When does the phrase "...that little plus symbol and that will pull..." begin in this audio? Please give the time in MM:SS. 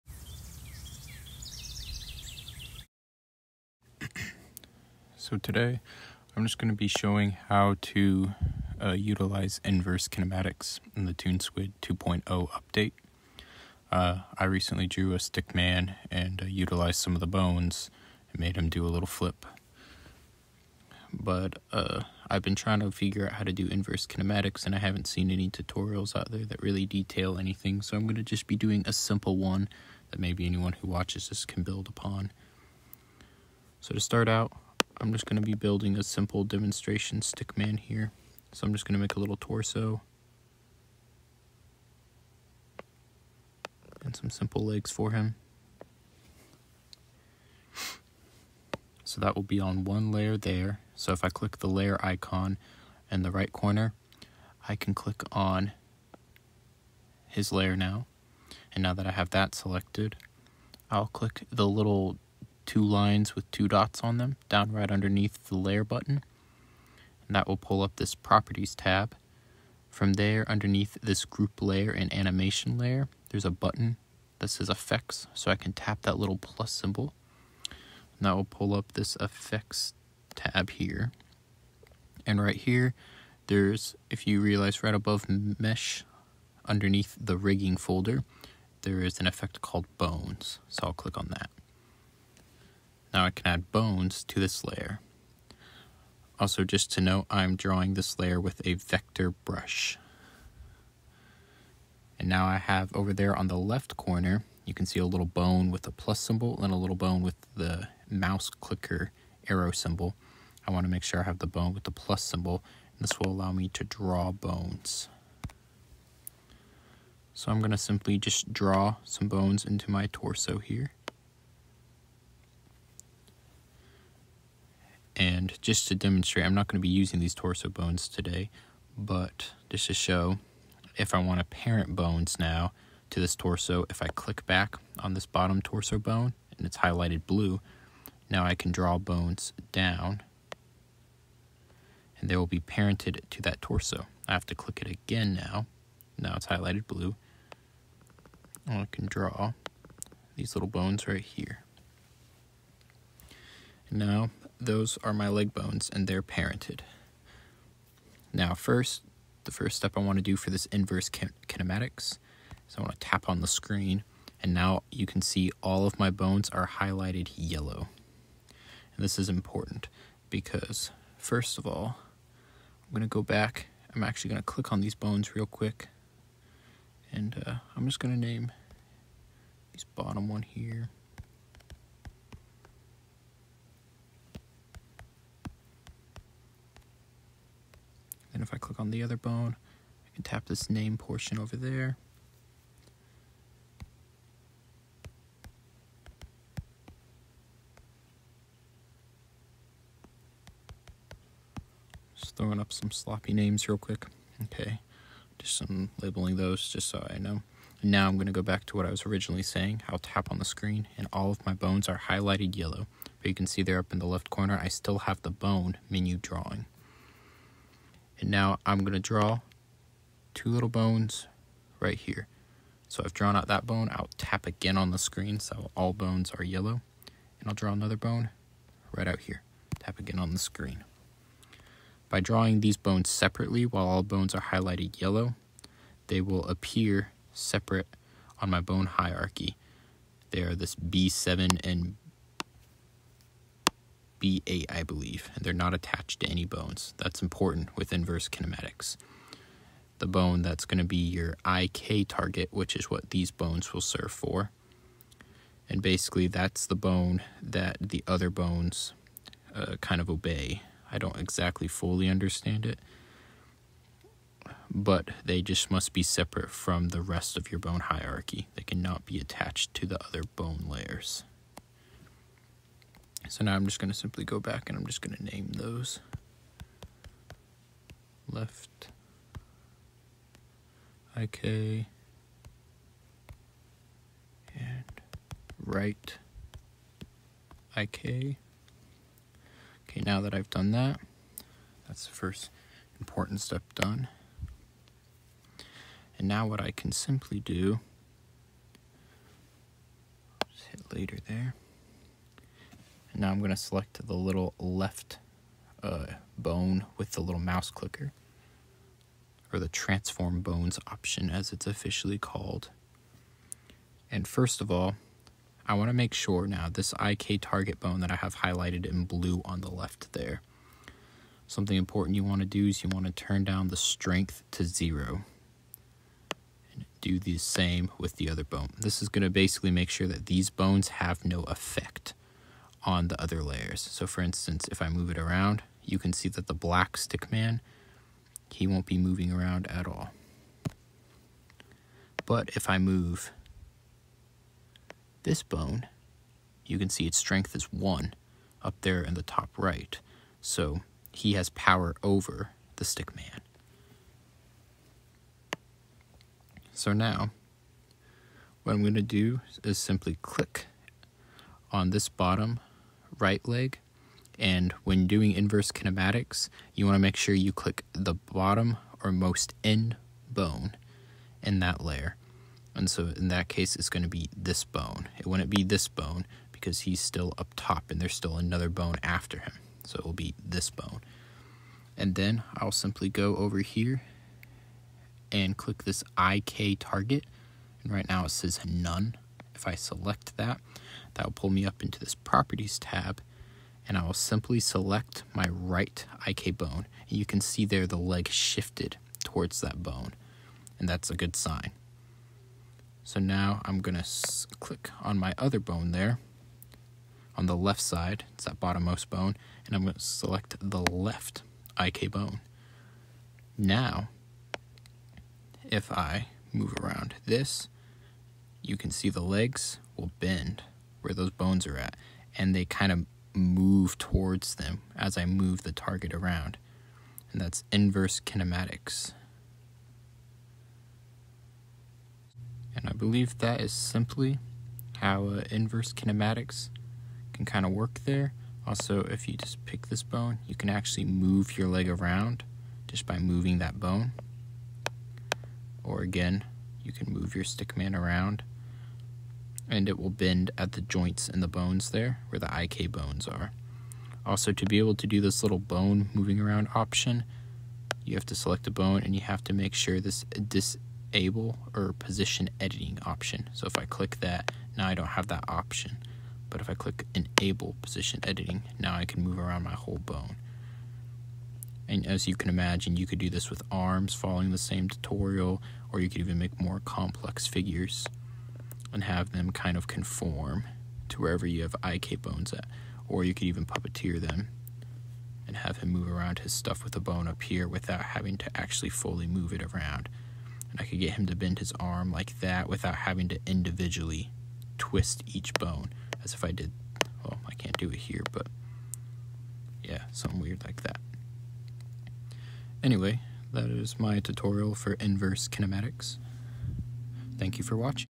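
01:16.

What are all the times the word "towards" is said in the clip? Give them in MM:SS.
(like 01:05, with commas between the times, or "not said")
06:39, 07:03.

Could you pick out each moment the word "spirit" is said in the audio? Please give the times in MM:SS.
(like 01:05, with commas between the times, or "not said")
not said.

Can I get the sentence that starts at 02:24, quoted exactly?
I have to click it again now.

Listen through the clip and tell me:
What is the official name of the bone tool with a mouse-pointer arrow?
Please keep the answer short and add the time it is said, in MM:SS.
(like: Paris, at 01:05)
transform bones, at 05:09.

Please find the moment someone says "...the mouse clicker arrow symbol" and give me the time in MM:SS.
01:47.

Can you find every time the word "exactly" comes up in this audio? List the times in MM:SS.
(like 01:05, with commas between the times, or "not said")
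04:21.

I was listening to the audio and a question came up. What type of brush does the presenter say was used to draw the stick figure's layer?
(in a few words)
vector brush.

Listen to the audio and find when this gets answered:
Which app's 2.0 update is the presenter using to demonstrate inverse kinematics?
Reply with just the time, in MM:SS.
00:11.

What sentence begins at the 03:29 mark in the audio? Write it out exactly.
I'll tap on the screen and all of my bones are highlighted yellow.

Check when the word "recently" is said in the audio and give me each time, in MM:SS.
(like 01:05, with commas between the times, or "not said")
00:14.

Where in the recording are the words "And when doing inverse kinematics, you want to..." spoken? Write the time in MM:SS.
06:04.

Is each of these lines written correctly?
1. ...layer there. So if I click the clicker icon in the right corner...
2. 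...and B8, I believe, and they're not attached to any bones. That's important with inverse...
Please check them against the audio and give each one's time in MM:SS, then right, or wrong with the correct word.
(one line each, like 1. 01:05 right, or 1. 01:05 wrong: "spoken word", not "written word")
1. 00:50 wrong: "layer", not "clicker"
2. 04:01 right.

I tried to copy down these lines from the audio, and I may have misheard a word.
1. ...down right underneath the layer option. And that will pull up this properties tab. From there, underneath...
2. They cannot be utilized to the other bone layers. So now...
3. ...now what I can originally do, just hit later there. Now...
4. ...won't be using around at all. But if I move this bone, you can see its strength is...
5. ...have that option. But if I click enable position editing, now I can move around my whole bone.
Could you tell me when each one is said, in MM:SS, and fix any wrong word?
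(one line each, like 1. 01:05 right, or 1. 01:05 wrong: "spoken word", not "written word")
1. 01:04 wrong: "button", not "option"
2. 04:28 wrong: "attached", not "utilized"
3. 04:56 wrong: "simply", not "originally"
4. 05:38 wrong: "moving", not "using"
5. 07:45 right.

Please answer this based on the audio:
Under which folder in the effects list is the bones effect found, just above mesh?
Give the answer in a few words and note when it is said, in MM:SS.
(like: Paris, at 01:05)
rigging, at 01:27.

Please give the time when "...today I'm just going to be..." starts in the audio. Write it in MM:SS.
00:05.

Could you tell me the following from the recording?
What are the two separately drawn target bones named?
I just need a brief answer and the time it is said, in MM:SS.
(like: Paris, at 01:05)
left IK and right IK, at 04:38.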